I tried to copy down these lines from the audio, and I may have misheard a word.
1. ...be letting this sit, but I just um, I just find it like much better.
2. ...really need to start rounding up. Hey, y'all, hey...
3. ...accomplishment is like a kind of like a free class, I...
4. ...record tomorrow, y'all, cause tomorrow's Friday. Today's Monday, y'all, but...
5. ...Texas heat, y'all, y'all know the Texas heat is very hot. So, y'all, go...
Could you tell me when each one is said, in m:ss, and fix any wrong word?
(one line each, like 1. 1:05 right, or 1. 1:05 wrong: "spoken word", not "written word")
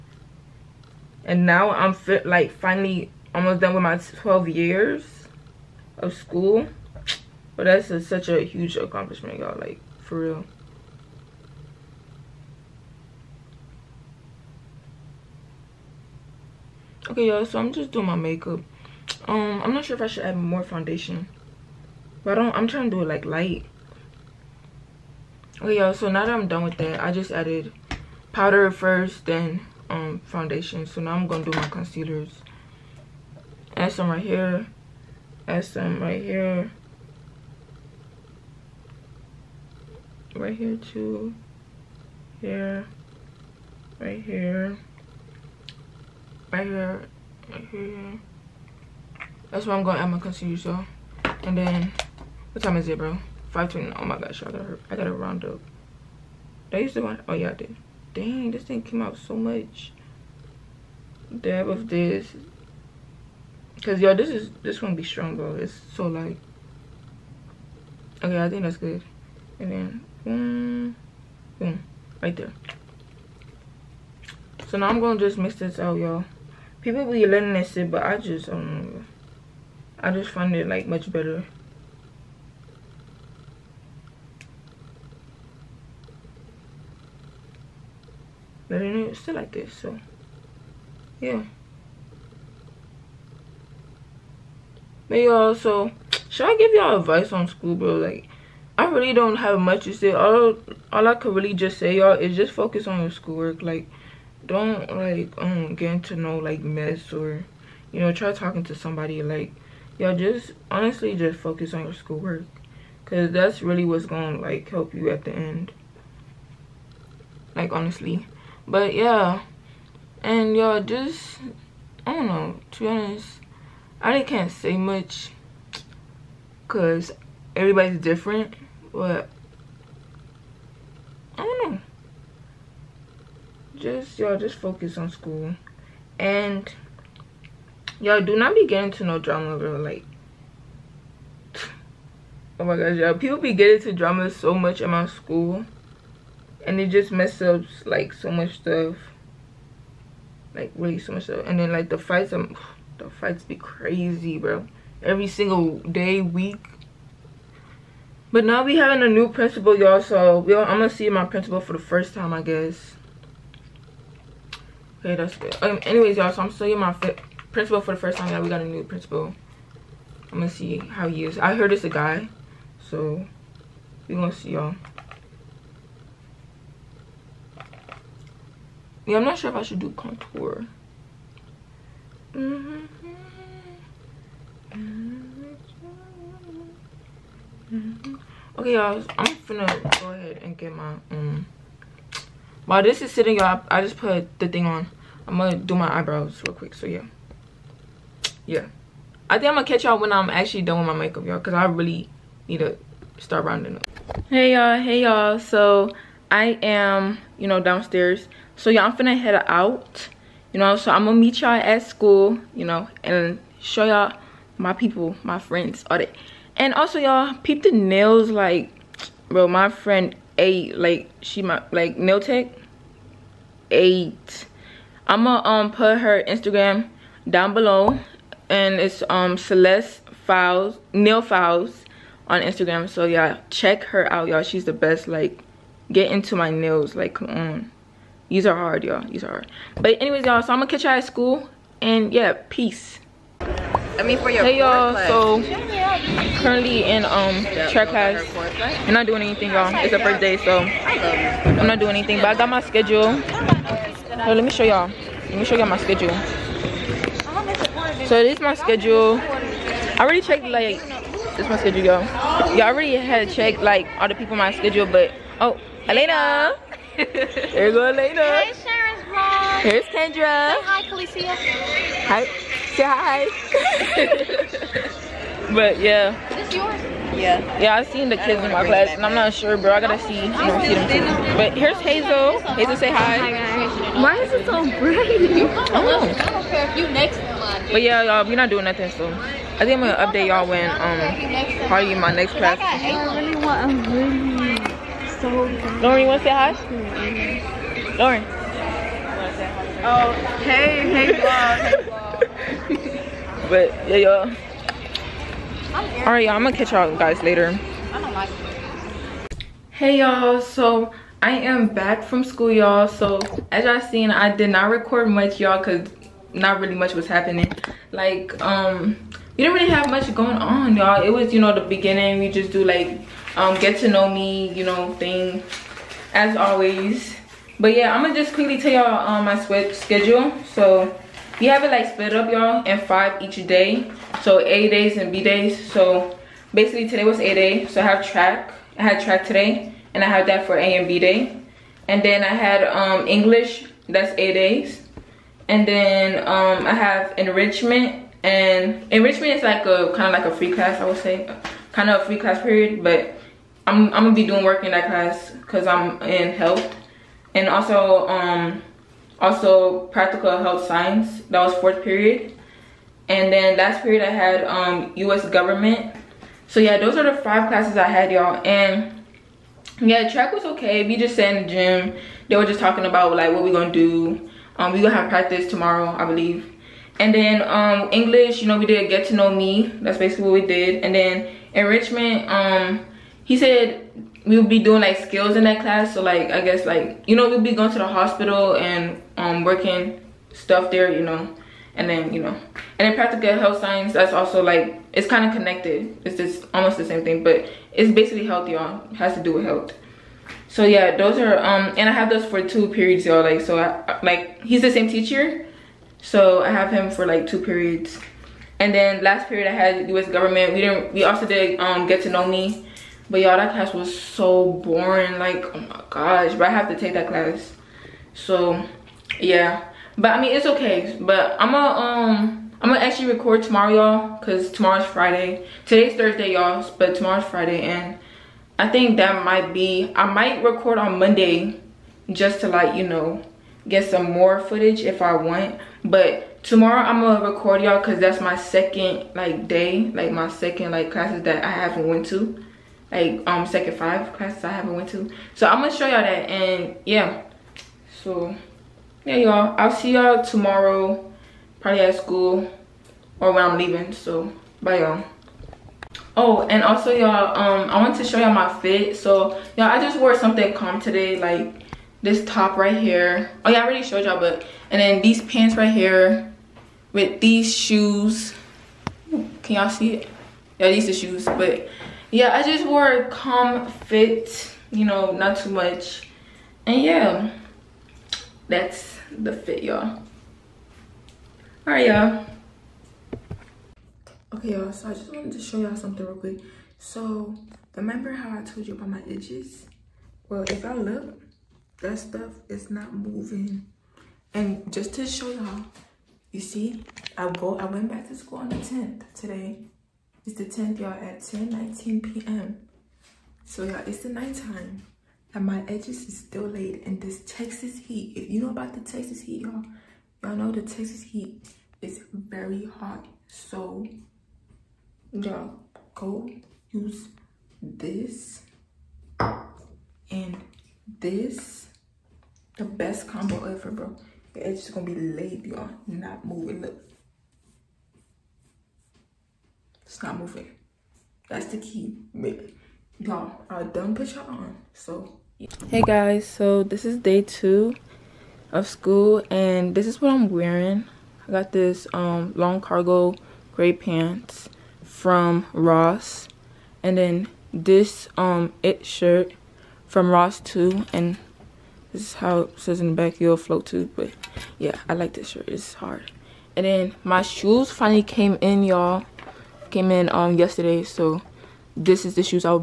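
1. 1:17 right
2. 3:21 right
3. 5:48 wrong: "enrichment", not "accomplishment"
4. 7:03 wrong: "Thursday", not "Monday"
5. 8:28 right.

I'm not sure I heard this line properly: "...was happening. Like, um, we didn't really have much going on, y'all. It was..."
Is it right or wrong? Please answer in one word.
right.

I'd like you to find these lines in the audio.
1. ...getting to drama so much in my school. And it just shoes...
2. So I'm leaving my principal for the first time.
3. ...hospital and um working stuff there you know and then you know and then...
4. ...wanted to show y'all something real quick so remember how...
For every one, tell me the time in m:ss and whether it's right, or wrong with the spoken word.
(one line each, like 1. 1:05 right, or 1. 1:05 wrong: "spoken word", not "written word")
1. 2:23 wrong: "messes", not "shoes"
2. 2:46 wrong: "seeing", not "leaving"
3. 6:27 right
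4. 8:05 right.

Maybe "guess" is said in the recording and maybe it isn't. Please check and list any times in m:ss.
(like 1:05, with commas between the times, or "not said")
2:42, 6:26.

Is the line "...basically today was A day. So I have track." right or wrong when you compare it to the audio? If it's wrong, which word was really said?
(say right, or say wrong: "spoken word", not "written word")
right.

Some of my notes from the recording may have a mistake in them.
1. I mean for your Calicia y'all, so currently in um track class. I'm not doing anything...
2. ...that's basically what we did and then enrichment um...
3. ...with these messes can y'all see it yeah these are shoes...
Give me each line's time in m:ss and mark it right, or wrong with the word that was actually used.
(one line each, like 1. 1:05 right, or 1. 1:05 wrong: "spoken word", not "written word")
1. 4:03 wrong: "Hey", not "Calicia"
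2. 6:19 right
3. 7:46 wrong: "shoes", not "messes".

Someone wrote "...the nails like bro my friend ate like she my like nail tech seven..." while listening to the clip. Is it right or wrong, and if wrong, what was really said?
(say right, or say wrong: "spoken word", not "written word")
wrong: "eight", not "seven".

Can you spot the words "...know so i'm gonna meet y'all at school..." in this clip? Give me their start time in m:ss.
3:30.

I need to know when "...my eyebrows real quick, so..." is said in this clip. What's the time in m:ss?
3:15.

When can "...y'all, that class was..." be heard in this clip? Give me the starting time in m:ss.
6:53.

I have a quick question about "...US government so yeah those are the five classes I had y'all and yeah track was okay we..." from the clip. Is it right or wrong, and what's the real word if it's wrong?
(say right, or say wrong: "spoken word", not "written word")
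right.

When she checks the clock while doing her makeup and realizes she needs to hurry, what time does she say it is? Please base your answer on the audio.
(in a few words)
5:20.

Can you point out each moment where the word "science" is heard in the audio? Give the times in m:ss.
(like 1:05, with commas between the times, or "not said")
6:00, 6:33.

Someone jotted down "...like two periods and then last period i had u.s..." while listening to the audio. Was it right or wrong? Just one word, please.
right.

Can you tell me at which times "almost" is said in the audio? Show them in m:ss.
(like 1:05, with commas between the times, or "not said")
0:03, 6:36.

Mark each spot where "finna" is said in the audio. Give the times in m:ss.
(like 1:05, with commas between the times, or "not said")
3:09, 3:28.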